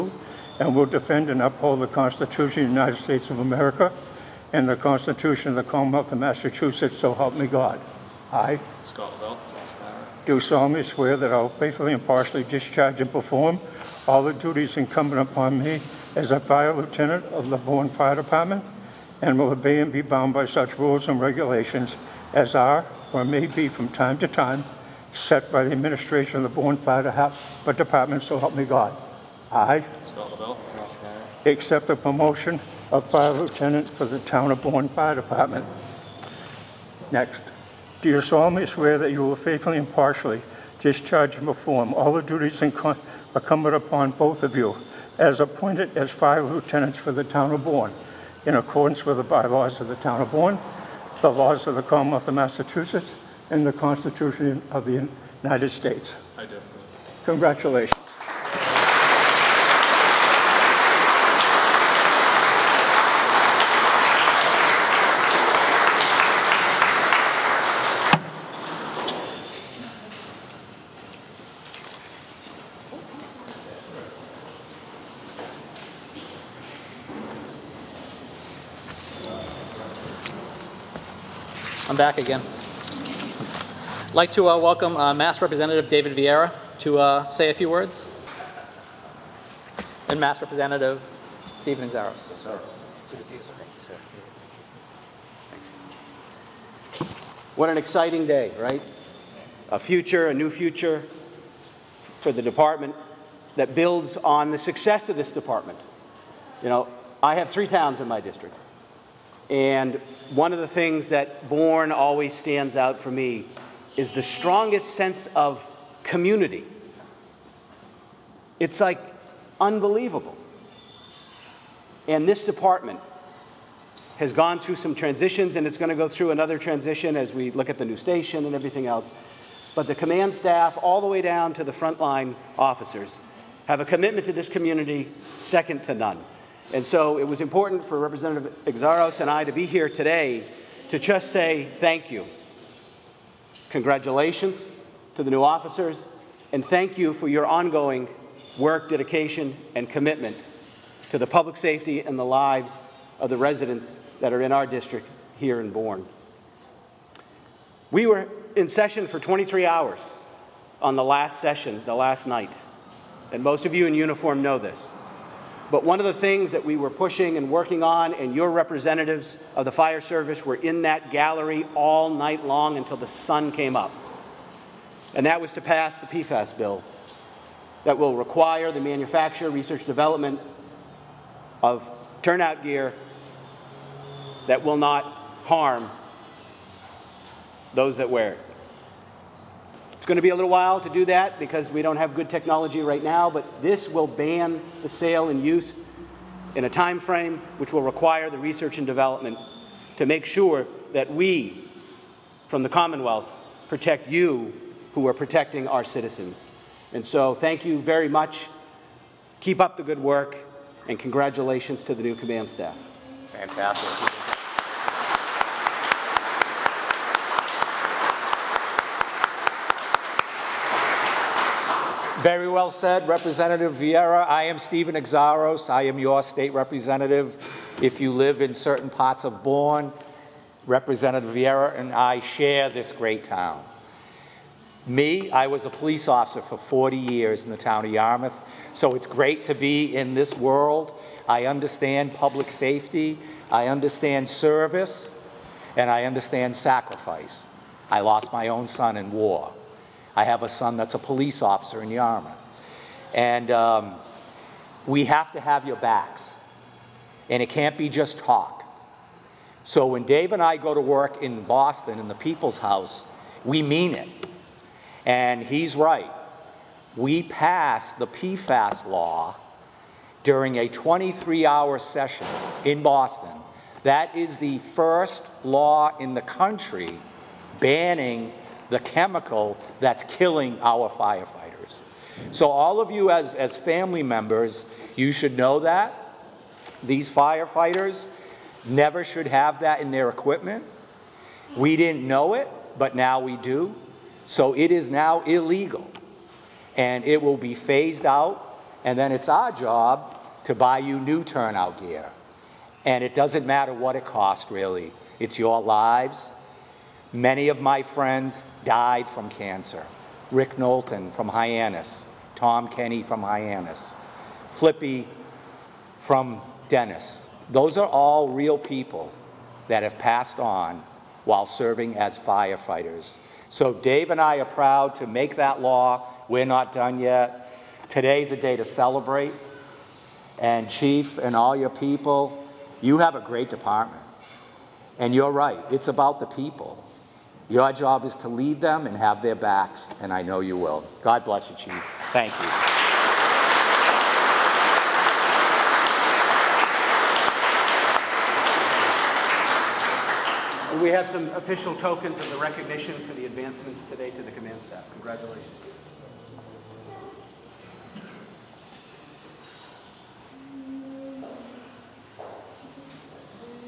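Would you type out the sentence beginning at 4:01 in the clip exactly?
I understand public safety, I understand service, and I understand sacrifice.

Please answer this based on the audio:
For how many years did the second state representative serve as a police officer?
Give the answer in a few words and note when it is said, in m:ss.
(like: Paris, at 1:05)
40, at 3:56.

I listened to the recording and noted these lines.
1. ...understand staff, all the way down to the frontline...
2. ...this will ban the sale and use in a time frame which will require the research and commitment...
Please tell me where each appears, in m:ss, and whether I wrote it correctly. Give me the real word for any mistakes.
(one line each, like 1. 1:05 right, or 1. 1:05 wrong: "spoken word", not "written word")
1. 2:09 wrong: "command", not "understand"
2. 3:13 wrong: "development", not "commitment".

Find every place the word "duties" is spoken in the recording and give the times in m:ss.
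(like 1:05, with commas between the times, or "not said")
0:14, 0:42.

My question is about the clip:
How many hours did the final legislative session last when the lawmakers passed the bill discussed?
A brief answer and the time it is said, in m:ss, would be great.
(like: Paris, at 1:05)
23, at 2:39.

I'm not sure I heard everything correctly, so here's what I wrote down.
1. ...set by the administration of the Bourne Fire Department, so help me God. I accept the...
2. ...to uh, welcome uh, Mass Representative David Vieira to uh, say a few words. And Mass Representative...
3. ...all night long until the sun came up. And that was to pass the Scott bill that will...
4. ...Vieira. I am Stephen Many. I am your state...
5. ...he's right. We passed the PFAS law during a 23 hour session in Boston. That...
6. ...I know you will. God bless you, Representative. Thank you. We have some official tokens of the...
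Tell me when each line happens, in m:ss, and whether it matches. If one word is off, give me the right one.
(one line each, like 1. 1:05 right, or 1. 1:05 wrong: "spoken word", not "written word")
1. 0:25 right
2. 1:24 right
3. 2:51 wrong: "PFAS", not "Scott"
4. 3:43 wrong: "Xiarhos", not "Many"
5. 4:25 right
6. 5:40 wrong: "Chief", not "Representative".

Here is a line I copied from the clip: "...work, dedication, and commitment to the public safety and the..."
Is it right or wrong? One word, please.
right.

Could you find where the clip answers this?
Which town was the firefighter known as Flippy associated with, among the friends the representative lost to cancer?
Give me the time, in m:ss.
5:16.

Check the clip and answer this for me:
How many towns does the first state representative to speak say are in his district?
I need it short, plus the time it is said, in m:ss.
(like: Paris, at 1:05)
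3, at 1:47.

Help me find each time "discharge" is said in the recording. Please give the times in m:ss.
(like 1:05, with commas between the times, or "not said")
0:12, 0:40.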